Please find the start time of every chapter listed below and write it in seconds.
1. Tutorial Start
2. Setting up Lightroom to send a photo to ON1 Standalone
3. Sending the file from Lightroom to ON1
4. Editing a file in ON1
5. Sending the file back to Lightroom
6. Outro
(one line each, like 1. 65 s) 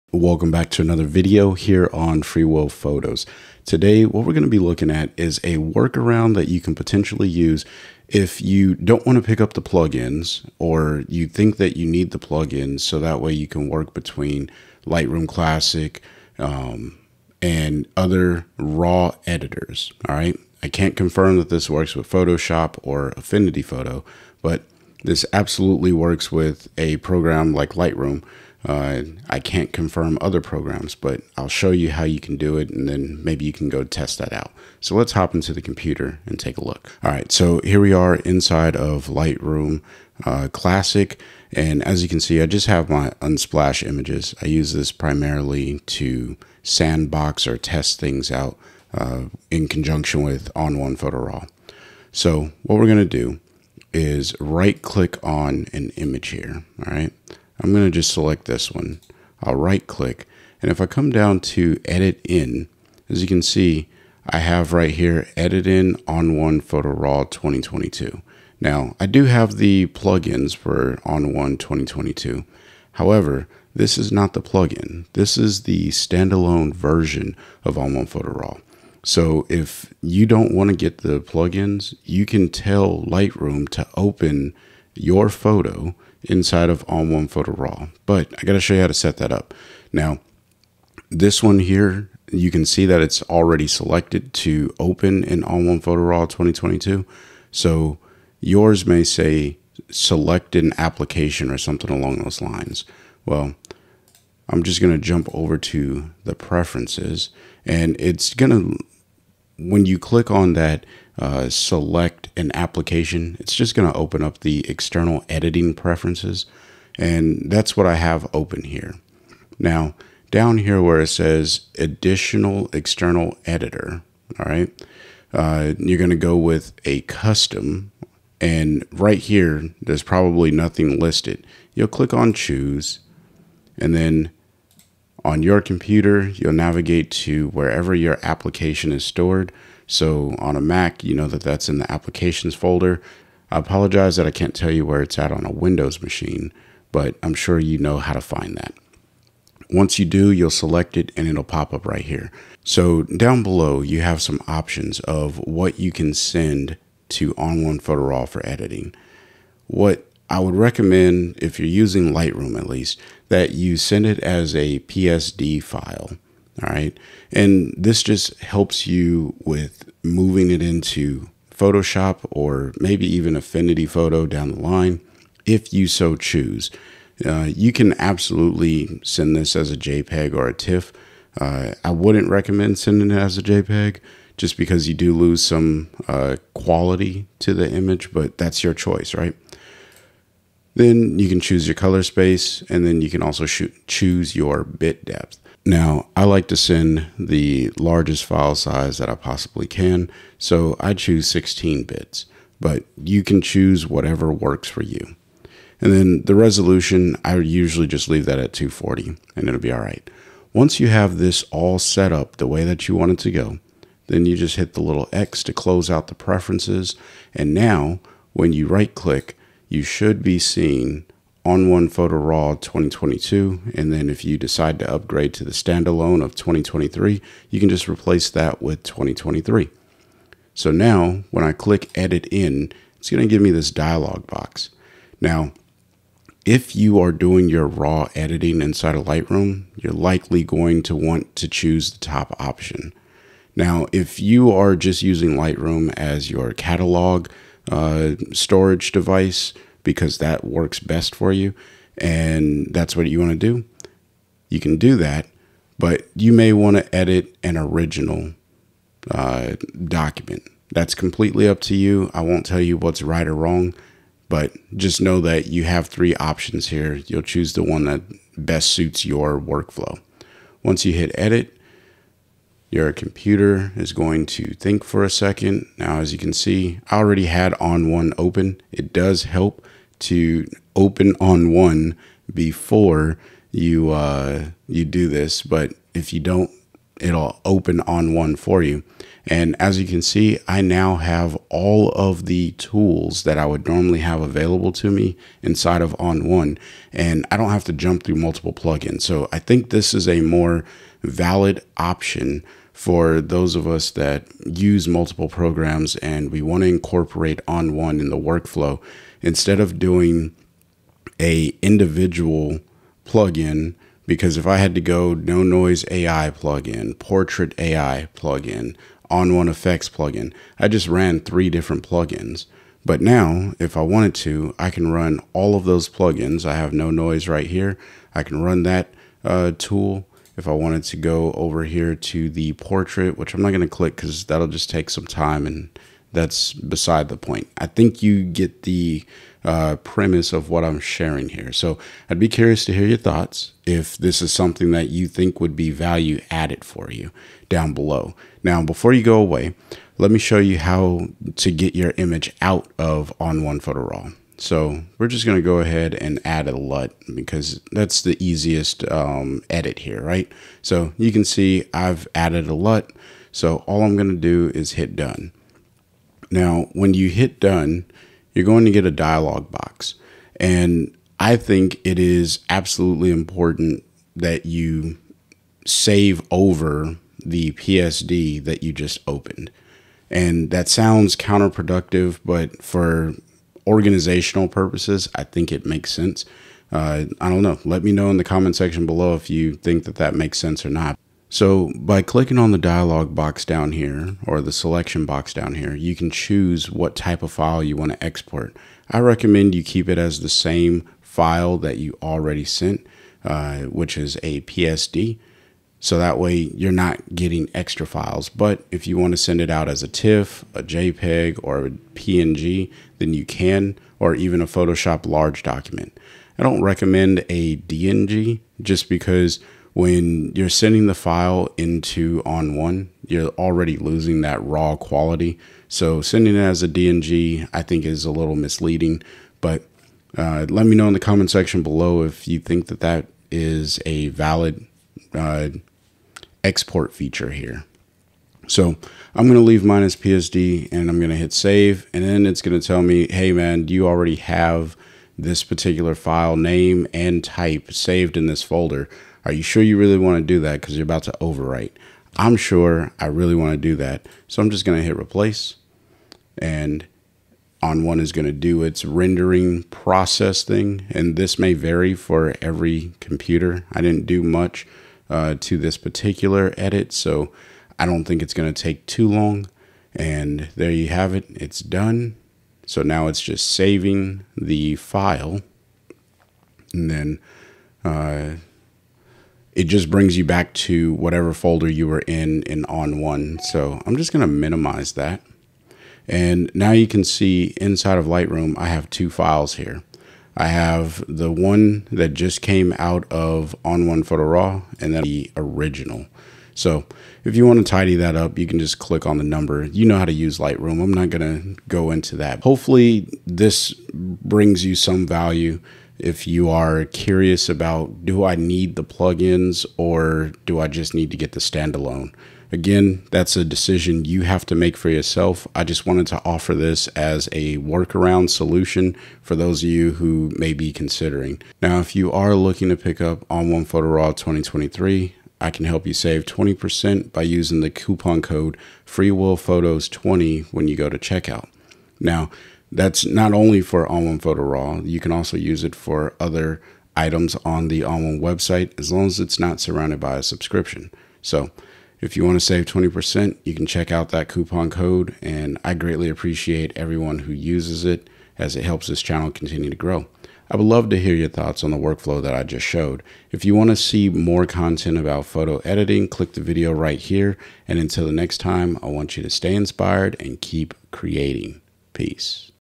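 1. 37 s
2. 102 s
3. 230 s
4. 280 s
5. 362 s
6. 502 s.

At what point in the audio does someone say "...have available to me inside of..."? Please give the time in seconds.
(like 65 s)
293 s.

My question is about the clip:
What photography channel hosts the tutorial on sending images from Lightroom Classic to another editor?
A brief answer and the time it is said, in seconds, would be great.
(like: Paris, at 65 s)
Free Will Photos, at 2 s.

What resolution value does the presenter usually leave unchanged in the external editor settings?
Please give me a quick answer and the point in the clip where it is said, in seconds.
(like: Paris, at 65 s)
240, at 208 s.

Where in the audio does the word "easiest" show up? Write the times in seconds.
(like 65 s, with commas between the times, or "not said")
358 s.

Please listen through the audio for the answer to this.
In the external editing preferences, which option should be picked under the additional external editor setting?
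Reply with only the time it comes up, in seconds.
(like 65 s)
127 s.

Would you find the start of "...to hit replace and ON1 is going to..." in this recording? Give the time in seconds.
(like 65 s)
454 s.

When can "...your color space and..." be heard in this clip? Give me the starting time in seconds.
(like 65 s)
191 s.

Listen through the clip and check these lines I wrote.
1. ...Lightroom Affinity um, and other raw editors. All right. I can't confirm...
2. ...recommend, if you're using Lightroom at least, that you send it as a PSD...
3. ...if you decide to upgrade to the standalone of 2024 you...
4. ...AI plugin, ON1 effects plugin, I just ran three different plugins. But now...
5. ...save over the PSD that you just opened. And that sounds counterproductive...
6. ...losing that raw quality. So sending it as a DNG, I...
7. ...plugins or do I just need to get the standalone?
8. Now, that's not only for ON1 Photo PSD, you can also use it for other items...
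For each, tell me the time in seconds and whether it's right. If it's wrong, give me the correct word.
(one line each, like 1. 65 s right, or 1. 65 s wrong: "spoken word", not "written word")
1. 14 s wrong: "Classic", not "Affinity"
2. 160 s right
3. 224 s wrong: "2023", not "2024"
4. 317 s right
5. 375 s right
6. 423 s right
7. 508 s right
8. 532 s wrong: "Raw", not "PSD".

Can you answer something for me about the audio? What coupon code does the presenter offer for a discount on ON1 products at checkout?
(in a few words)
FreeWillPhotos20.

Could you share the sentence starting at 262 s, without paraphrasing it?
I won't tell you what's right or wrong, but just know that you have three options here.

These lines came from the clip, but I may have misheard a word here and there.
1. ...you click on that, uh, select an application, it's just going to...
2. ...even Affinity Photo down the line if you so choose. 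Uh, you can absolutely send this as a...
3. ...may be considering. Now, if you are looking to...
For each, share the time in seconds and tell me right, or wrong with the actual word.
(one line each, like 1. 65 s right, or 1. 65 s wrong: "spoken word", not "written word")
1. 109 s right
2. 173 s right
3. 520 s right.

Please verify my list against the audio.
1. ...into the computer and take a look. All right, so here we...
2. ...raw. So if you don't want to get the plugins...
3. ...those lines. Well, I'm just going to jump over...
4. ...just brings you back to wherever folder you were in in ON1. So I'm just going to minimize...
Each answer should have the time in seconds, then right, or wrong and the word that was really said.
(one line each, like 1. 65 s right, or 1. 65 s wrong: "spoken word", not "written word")
1. 35 s right
2. 78 s right
3. 102 s right
4. 479 s wrong: "whatever", not "wherever".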